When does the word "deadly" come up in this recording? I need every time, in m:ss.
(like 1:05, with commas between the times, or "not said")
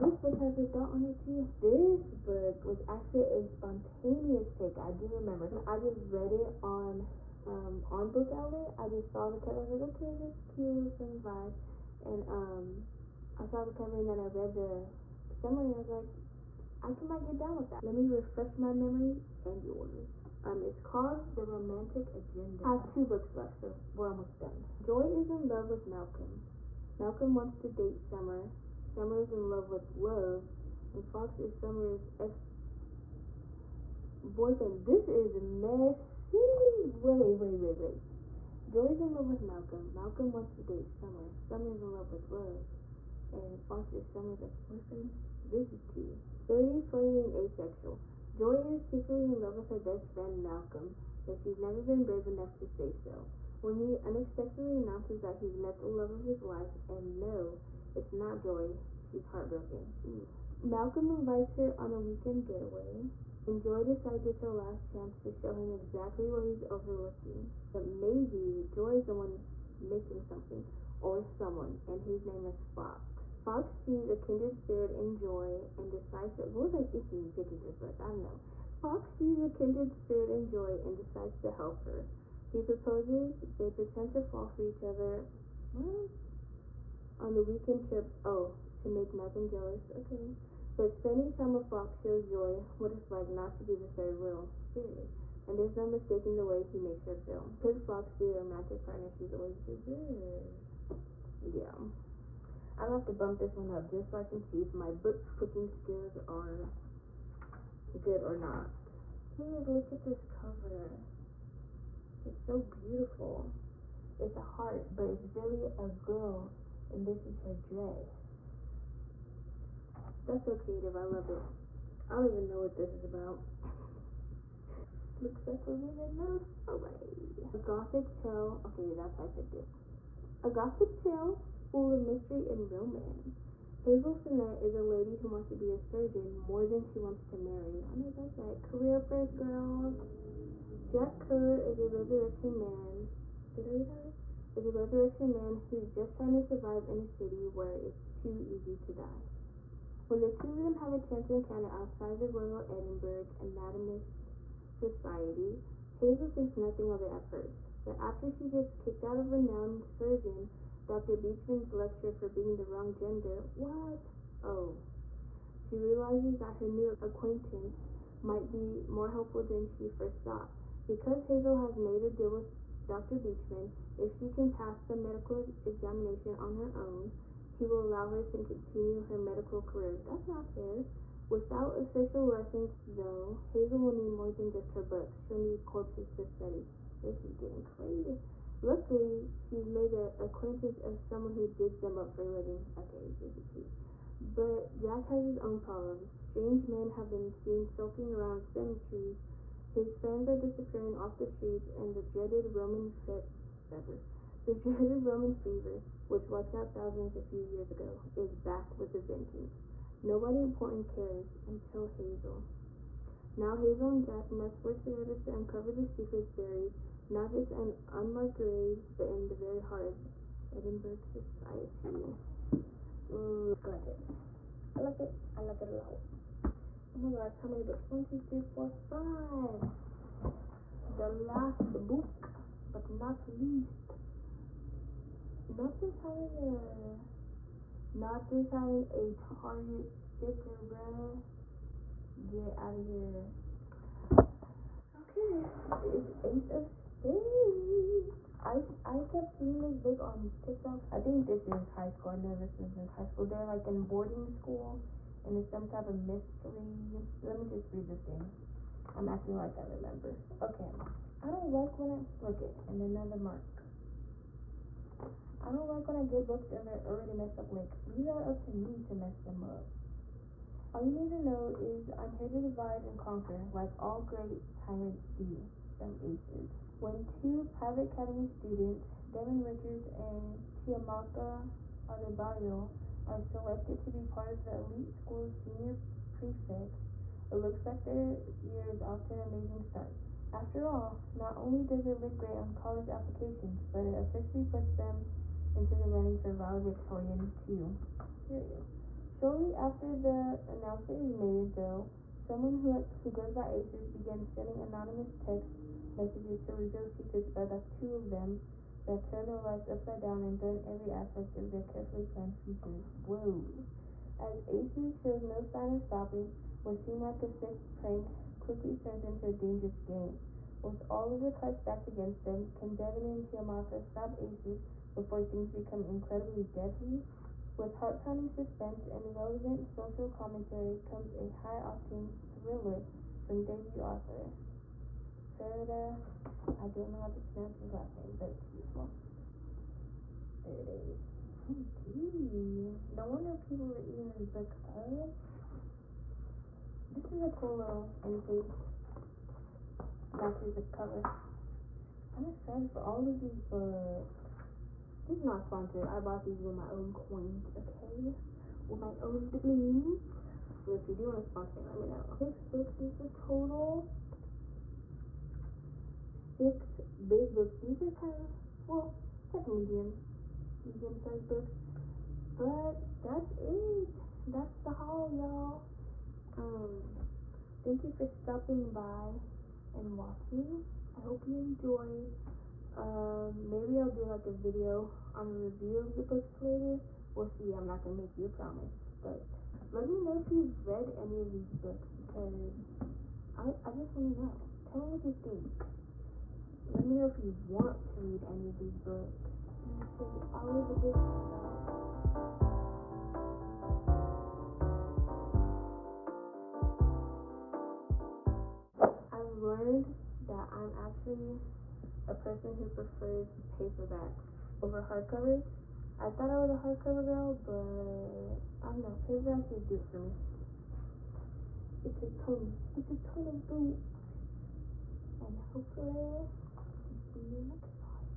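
5:26.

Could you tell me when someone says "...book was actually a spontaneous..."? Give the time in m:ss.
0:02.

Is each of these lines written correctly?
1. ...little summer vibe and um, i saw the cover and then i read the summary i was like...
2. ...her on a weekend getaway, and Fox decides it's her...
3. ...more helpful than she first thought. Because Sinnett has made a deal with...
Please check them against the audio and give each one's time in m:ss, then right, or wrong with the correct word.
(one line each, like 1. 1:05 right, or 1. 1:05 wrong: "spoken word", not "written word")
1. 0:10 right
2. 1:01 wrong: "Joy", not "Fox"
3. 2:48 wrong: "Hazel", not "Sinnett".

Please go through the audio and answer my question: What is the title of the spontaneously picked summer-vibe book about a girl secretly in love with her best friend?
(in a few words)
The Romantic Agenda.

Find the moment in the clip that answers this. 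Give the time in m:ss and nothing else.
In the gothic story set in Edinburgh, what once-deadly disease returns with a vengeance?
3:24.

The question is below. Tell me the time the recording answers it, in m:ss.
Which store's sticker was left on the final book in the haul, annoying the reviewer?
3:59.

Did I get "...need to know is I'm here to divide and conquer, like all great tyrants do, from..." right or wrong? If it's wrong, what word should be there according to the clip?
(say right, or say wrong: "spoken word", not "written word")
right.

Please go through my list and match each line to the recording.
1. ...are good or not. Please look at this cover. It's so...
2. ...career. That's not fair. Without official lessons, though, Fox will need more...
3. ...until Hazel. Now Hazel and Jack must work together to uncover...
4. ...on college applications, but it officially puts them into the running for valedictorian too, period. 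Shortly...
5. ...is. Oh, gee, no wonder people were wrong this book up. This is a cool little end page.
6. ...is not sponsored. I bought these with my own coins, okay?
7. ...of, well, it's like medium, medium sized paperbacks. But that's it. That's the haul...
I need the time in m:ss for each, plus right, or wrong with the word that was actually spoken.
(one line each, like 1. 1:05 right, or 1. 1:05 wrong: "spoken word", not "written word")
1. 1:46 right
2. 2:59 wrong: "Hazel", not "Fox"
3. 3:31 right
4. 4:52 right
5. 5:40 wrong: "eating", not "wrong"
6. 5:55 right
7. 6:08 wrong: "books", not "paperbacks".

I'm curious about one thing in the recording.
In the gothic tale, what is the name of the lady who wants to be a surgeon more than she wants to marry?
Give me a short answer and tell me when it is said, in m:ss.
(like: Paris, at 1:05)
Hazel Sinnett, at 2:13.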